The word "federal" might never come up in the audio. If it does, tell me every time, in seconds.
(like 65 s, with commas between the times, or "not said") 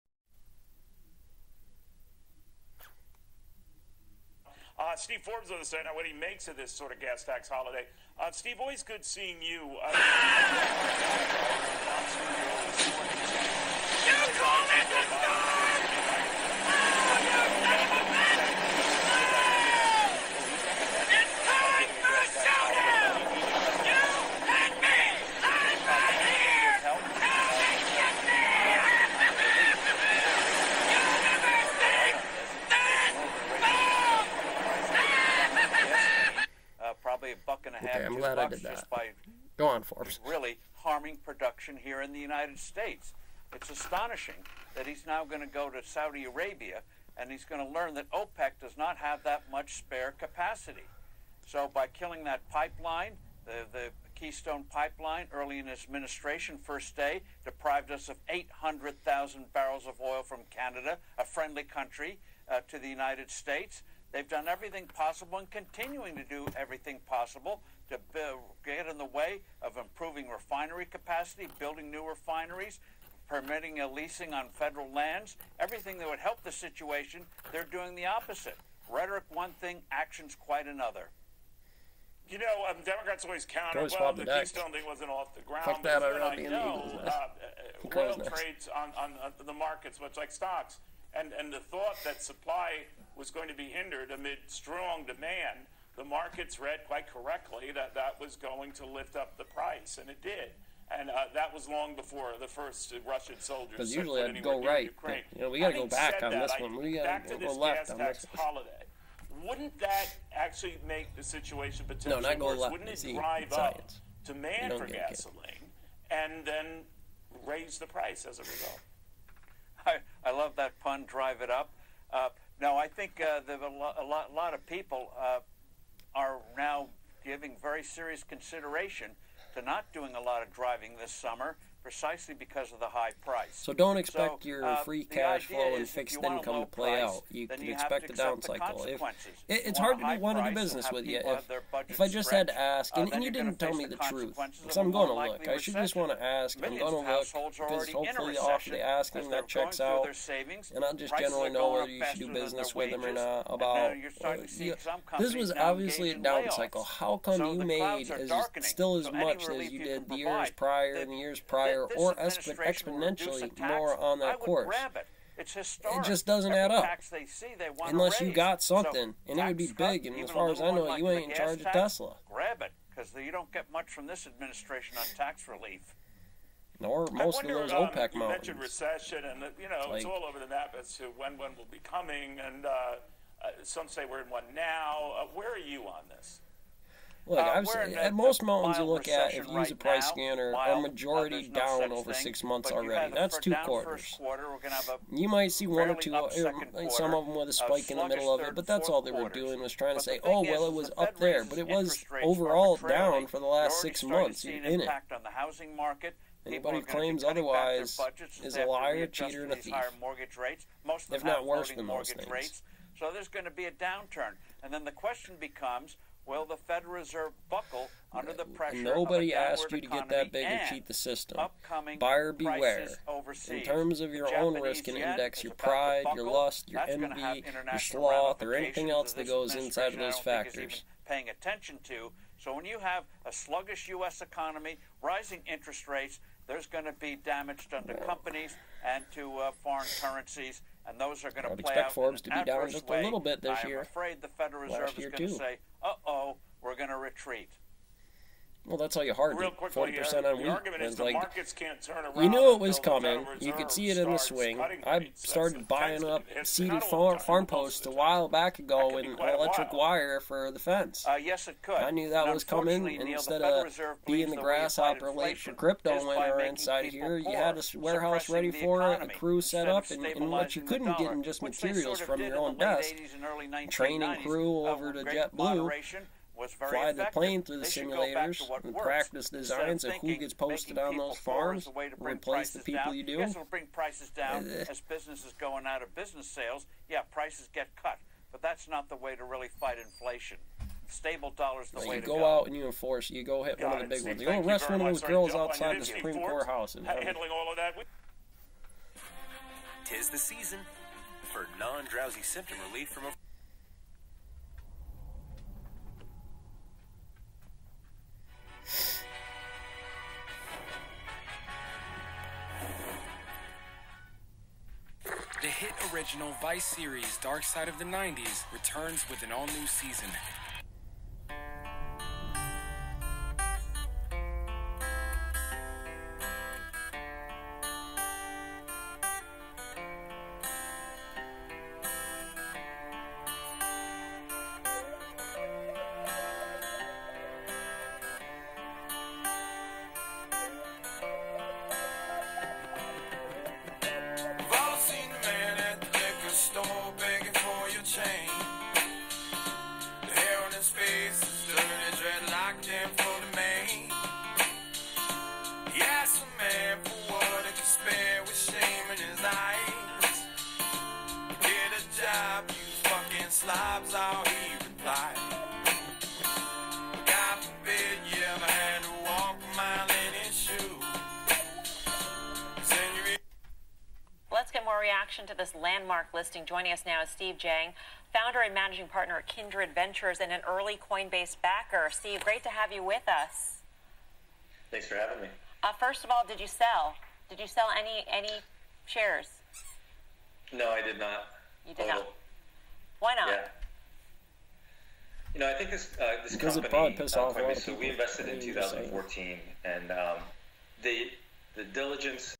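74 s, 216 s, 244 s.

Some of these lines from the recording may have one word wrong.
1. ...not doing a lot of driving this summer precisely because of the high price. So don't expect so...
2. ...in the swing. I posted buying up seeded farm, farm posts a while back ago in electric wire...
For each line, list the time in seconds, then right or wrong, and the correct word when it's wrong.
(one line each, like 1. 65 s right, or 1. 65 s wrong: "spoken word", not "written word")
1. 129 s right
2. 253 s wrong: "started", not "posted".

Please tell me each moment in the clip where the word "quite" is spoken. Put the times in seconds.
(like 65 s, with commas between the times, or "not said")
80 s, 96 s.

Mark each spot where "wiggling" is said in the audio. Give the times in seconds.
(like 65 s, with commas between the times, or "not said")
not said.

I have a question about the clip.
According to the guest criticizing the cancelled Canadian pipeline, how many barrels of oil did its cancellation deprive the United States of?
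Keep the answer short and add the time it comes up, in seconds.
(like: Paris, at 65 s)
800,000 barrels, at 58 s.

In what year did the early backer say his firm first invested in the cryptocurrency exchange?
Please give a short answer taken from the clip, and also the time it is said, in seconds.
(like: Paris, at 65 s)
2014, at 398 s.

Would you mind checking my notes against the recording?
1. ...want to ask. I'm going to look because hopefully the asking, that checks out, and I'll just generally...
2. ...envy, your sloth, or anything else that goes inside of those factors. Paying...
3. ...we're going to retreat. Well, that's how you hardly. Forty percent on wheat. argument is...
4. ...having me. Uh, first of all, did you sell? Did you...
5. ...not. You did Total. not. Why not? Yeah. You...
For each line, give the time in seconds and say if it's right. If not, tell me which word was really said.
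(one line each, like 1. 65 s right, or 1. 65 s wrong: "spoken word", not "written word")
1. 145 s right
2. 226 s right
3. 246 s right
4. 384 s right
5. 390 s right.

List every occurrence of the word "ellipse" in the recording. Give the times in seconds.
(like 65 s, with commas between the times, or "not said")
not said.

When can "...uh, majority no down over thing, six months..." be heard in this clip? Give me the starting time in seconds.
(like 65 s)
190 s.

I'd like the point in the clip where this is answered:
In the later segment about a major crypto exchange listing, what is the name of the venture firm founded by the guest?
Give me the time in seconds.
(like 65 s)
379 s.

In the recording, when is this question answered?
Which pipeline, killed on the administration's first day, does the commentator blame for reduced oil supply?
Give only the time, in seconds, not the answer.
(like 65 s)
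54 s.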